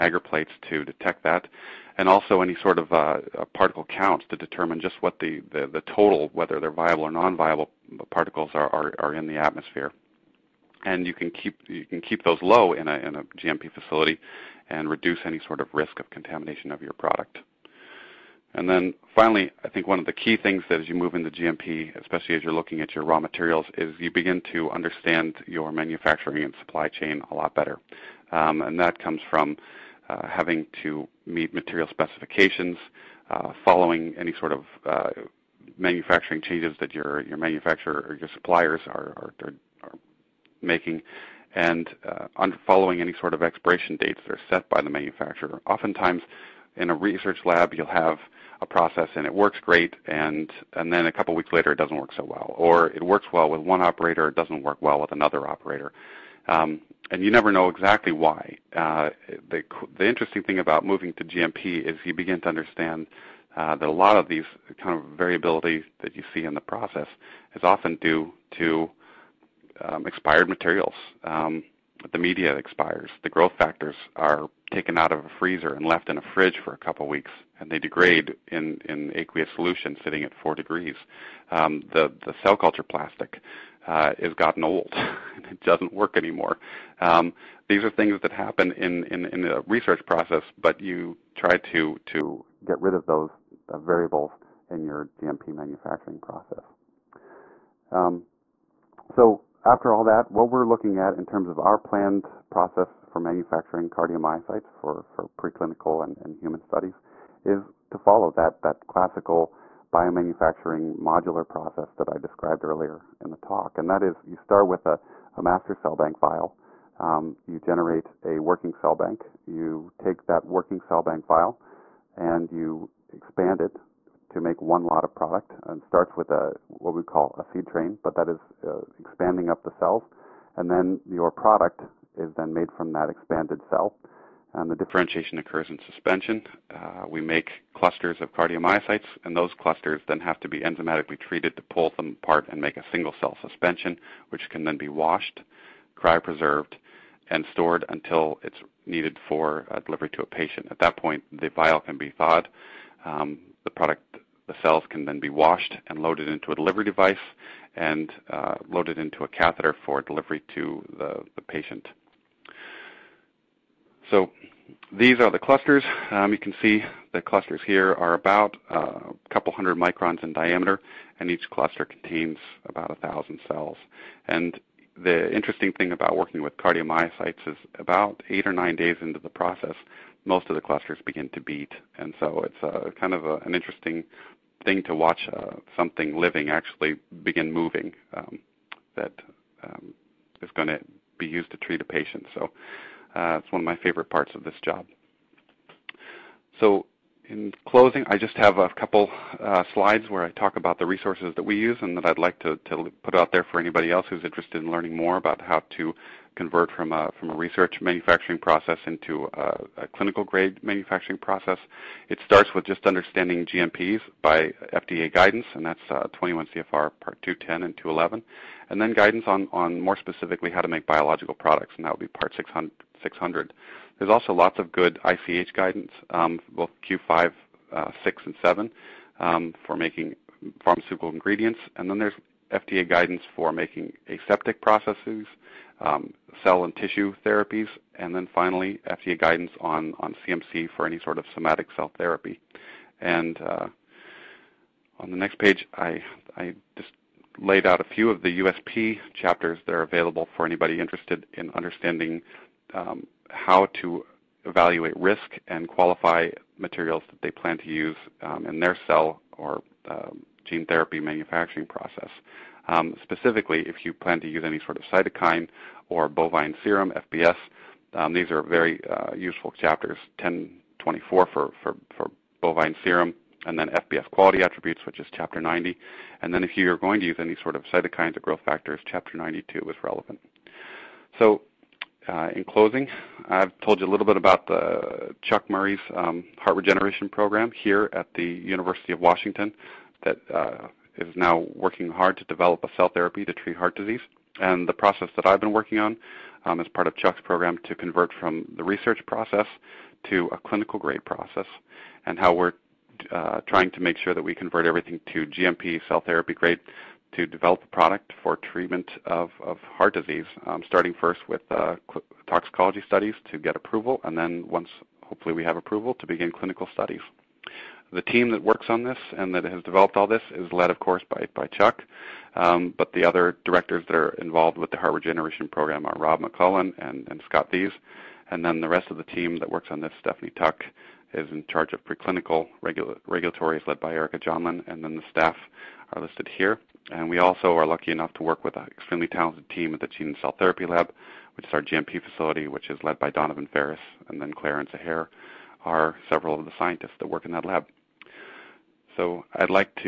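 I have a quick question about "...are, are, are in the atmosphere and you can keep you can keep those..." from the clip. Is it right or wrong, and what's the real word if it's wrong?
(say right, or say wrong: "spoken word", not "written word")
right.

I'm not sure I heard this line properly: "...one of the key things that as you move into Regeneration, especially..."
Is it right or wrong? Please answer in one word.
wrong.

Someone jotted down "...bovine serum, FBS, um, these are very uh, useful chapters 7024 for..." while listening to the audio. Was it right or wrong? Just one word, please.
wrong.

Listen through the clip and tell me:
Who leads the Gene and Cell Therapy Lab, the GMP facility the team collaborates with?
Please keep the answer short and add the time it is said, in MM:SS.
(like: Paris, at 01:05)
Donovan Ferris, at 05:43.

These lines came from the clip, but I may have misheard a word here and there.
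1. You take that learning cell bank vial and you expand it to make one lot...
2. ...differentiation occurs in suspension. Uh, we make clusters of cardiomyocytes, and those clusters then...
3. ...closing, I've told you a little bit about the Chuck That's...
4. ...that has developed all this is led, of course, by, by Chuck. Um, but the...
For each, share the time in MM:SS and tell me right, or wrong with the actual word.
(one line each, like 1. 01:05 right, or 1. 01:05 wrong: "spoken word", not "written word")
1. 01:59 wrong: "working", not "learning"
2. 02:14 right
3. 04:42 wrong: "Murry", not "That"
4. 05:19 right.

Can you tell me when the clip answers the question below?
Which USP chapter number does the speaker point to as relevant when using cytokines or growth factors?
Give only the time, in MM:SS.
04:38.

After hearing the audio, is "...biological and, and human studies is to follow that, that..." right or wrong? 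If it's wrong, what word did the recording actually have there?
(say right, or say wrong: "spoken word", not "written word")
wrong: "preclinical", not "biological".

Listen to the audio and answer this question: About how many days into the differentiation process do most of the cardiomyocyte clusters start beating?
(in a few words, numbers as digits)
8 or 9 days.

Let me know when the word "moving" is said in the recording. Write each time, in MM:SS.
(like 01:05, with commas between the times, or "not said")
01:00, 03:07.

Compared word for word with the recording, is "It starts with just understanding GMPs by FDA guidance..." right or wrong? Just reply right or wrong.
right.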